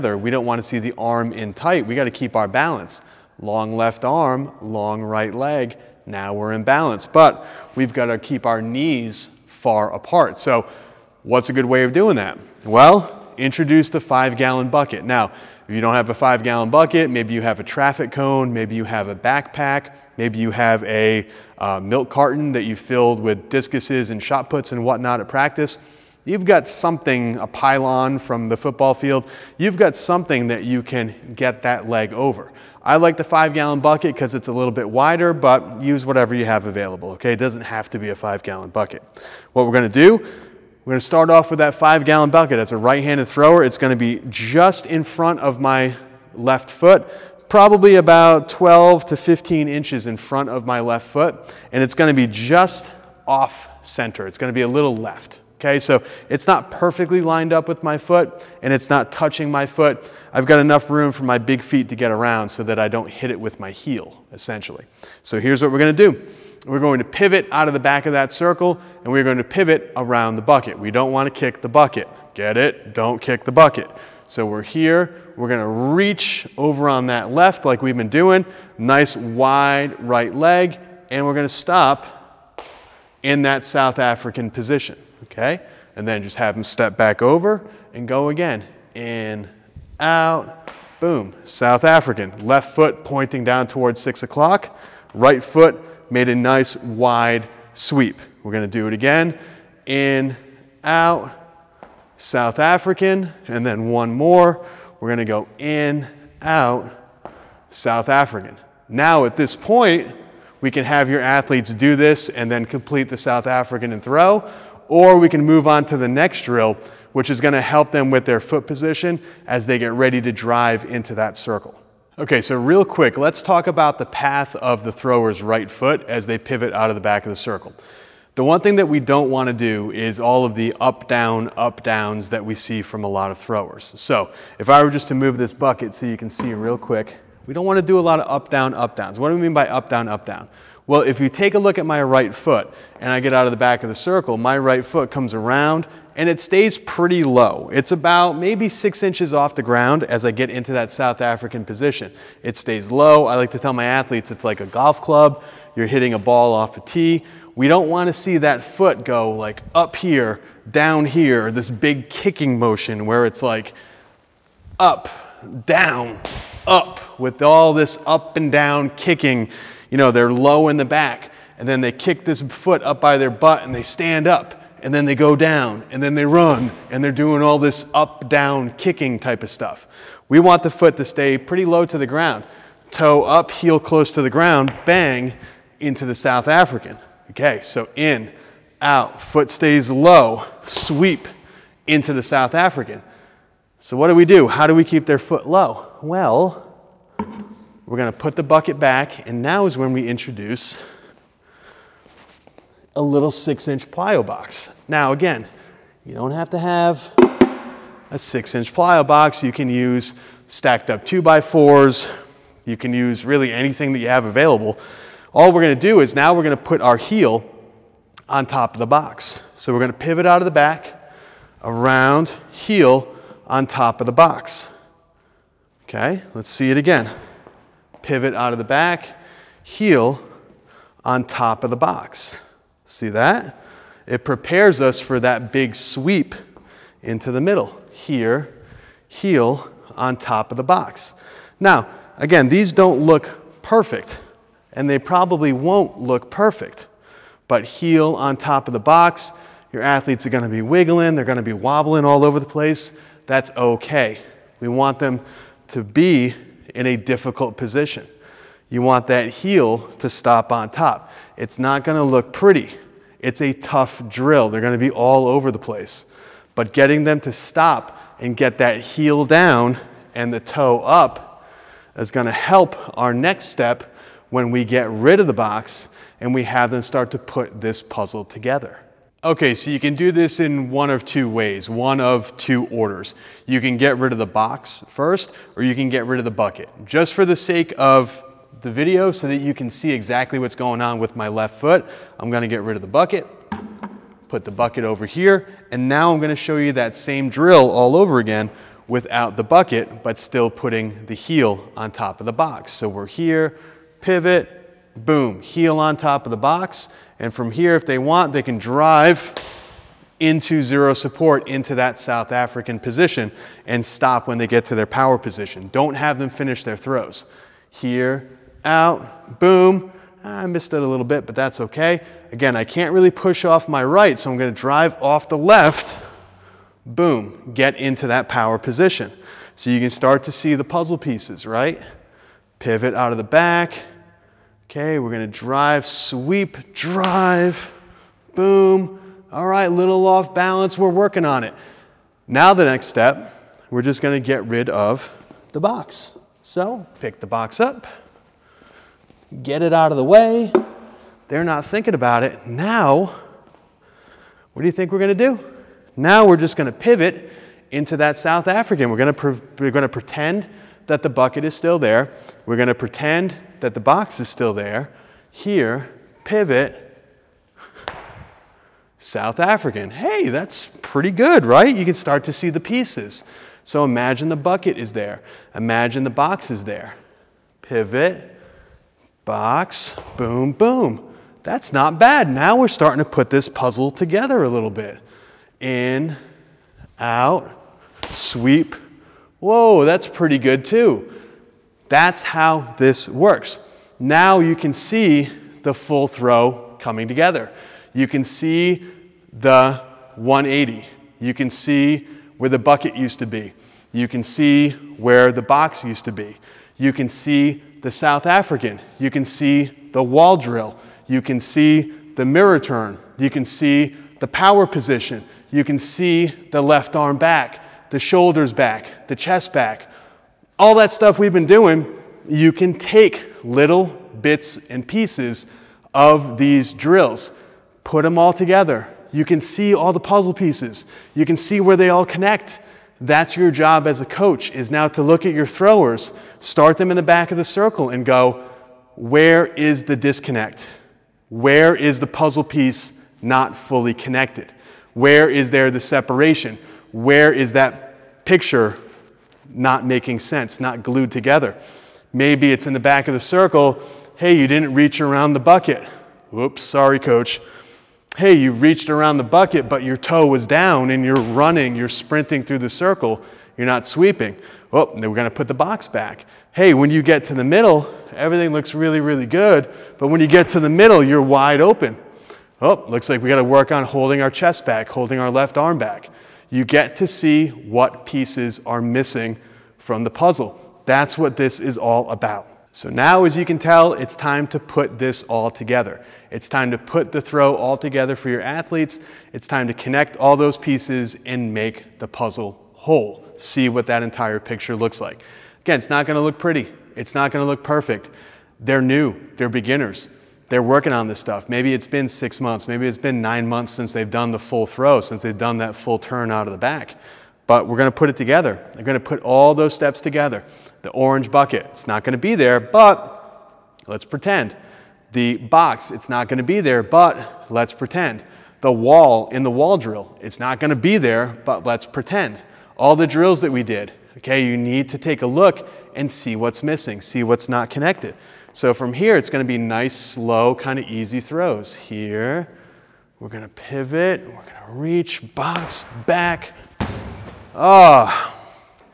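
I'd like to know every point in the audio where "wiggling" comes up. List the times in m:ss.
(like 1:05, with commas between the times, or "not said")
4:10.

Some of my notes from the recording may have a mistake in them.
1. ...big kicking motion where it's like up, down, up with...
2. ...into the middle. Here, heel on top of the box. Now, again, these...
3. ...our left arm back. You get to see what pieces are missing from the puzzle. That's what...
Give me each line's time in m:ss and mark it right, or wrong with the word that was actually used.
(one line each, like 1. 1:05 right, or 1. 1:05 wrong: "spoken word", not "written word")
1. 2:41 right
2. 3:57 right
3. 7:55 right.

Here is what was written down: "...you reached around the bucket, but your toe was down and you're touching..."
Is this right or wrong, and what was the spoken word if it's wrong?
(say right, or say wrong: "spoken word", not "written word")
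wrong: "running", not "touching".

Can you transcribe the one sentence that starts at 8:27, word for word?
But we're going to put it together.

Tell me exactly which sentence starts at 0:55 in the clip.
So it's not perfectly lined up with my foot and it's not touching my foot.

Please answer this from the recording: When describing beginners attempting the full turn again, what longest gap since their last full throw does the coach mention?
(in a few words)
9 months.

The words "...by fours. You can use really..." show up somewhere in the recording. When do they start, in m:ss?
3:31.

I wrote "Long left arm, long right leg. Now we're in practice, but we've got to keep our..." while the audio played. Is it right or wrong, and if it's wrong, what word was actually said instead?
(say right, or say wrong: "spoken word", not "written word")
wrong: "balance", not "practice".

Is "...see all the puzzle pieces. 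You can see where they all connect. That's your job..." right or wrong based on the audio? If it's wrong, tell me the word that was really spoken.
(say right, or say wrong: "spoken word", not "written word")
right.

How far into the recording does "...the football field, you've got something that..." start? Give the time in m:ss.
0:28.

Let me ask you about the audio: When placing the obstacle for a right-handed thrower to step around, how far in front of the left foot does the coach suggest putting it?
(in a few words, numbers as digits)
12 to 15 inches.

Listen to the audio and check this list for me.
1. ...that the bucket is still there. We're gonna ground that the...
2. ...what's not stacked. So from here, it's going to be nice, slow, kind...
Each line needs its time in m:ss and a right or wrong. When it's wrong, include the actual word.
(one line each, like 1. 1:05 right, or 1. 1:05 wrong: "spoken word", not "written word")
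1. 6:00 wrong: "pretend", not "ground"
2. 8:47 wrong: "connected", not "stacked".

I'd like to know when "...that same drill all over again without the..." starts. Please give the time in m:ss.
4:56.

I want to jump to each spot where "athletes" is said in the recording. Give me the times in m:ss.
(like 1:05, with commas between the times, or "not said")
1:51, 2:33, 4:09, 8:08.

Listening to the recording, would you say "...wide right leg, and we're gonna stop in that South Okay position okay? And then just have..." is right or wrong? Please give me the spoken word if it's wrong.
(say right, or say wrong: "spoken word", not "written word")
wrong: "African", not "Okay".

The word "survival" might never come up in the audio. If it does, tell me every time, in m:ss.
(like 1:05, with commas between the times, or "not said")
not said.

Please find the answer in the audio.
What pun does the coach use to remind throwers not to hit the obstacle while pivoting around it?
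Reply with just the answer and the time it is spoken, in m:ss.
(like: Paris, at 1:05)
Don't kick the bucket, at 1:12.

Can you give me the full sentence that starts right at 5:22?
Again, I can't really push off my right, so I'm going to drive off the left.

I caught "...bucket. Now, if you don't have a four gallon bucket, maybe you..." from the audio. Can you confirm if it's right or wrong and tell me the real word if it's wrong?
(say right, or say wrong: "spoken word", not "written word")
wrong: "five", not "four".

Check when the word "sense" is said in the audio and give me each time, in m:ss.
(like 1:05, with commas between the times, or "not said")
7:30.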